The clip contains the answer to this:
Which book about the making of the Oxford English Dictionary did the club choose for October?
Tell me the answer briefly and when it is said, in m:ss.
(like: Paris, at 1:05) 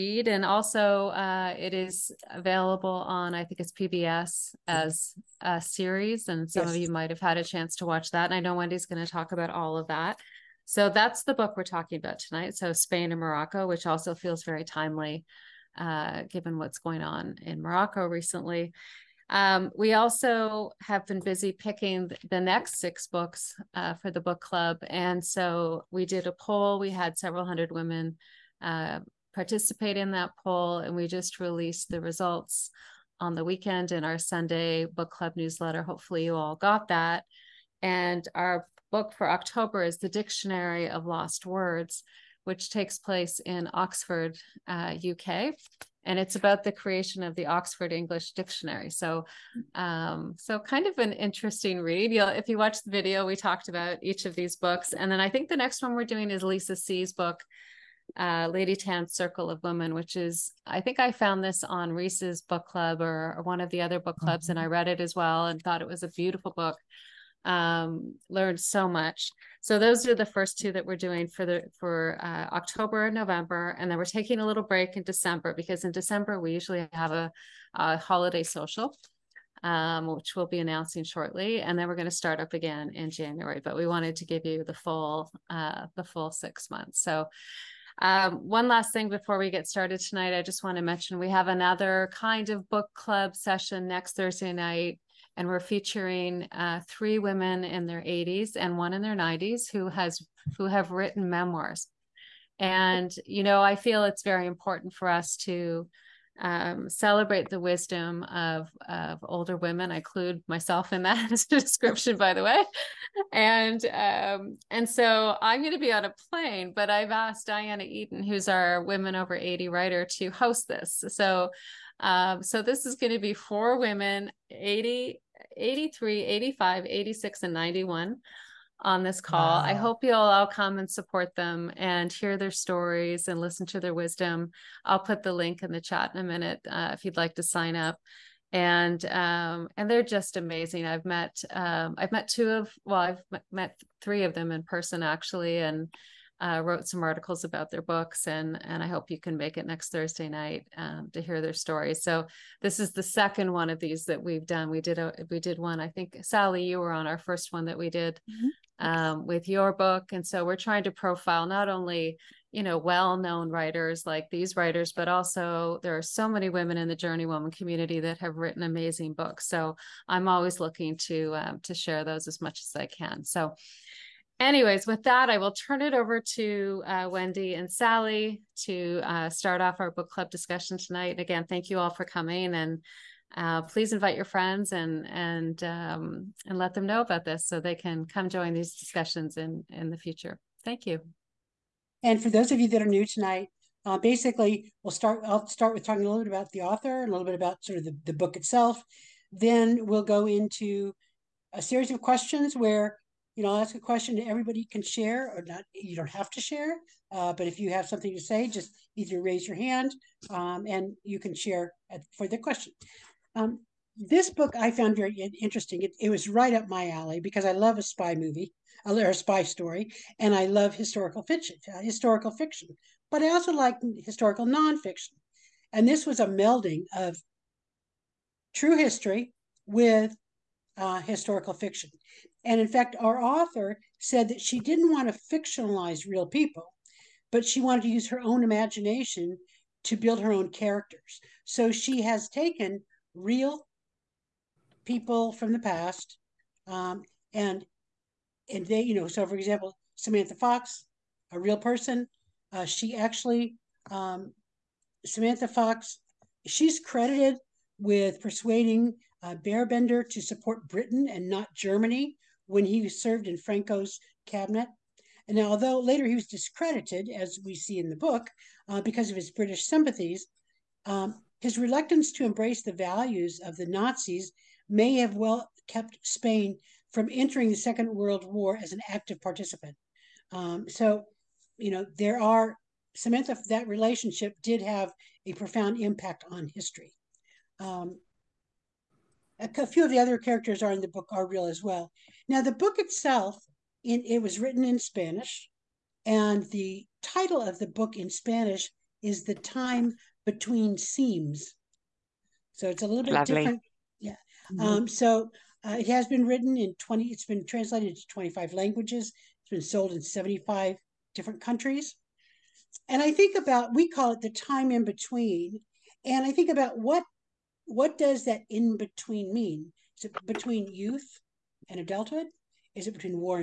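The Dictionary of Lost Words, at 0:39.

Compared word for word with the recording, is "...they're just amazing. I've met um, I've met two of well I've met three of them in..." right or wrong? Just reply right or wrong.
right.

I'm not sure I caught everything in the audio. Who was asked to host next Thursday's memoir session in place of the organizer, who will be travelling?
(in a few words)
Diana Eaton.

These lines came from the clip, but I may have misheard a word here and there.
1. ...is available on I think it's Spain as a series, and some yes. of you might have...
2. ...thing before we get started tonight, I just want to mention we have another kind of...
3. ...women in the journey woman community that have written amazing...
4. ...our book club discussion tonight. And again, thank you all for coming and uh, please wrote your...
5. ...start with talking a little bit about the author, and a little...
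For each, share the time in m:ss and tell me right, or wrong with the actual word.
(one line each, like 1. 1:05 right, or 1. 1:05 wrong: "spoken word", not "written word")
1. 0:01 wrong: "PBS", not "Spain"
2. 1:28 right
3. 2:46 right
4. 2:59 wrong: "invite", not "wrote"
5. 3:15 right.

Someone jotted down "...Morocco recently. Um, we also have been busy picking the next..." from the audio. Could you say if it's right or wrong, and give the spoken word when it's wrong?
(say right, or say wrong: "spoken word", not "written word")
right.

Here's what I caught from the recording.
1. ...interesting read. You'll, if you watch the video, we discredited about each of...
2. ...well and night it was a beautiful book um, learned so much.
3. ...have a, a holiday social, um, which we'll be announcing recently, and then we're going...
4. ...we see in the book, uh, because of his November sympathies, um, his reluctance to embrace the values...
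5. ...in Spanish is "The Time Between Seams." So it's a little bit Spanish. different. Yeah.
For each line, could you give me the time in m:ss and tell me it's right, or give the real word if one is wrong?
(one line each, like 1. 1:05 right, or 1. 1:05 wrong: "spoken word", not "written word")
1. 0:51 wrong: "talked", not "discredited"
2. 1:05 wrong: "thought", not "night"
3. 1:16 wrong: "shortly", not "recently"
4. 4:27 wrong: "British", not "November"
5. 4:57 wrong: "Lovely", not "Spanish".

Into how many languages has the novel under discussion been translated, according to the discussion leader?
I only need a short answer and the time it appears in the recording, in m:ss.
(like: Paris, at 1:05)
25, at 5:08.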